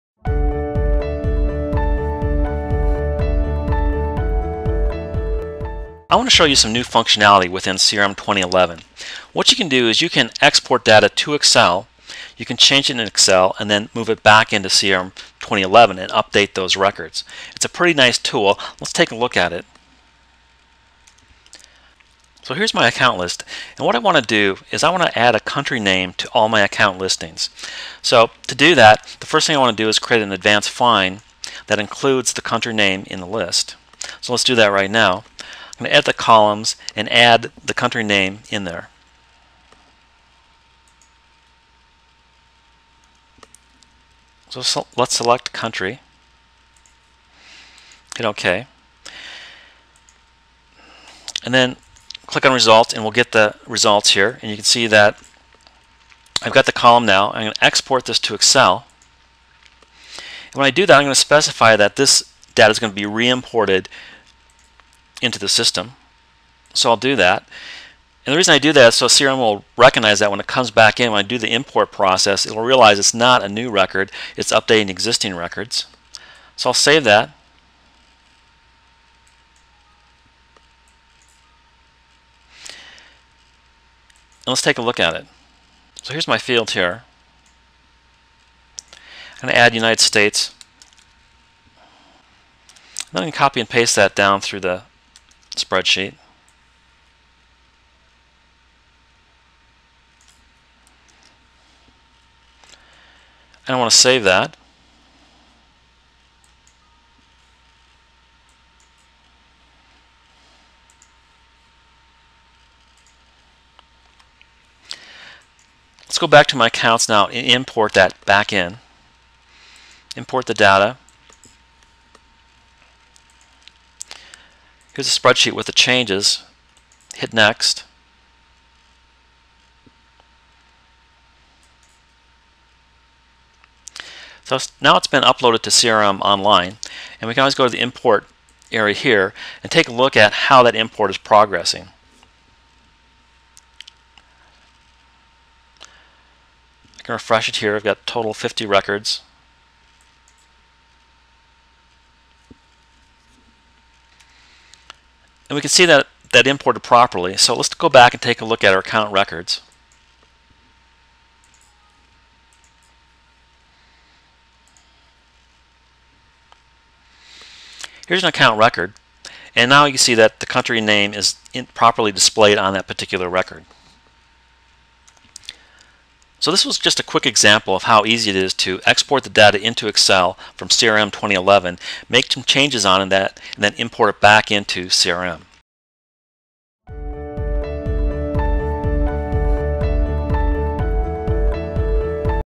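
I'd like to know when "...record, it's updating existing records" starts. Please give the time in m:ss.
1:13.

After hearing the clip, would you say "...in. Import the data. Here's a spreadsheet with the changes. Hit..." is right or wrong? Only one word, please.
right.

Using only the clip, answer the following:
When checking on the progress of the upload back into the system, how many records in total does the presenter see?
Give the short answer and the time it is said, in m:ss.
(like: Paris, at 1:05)
50, at 2:28.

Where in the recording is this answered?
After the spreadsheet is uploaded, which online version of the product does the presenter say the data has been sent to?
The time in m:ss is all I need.
2:15.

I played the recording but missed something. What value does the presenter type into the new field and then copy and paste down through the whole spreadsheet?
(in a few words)
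United States.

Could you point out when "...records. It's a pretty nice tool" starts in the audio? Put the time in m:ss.
0:16.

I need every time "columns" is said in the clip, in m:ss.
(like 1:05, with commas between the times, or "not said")
0:36, 0:56.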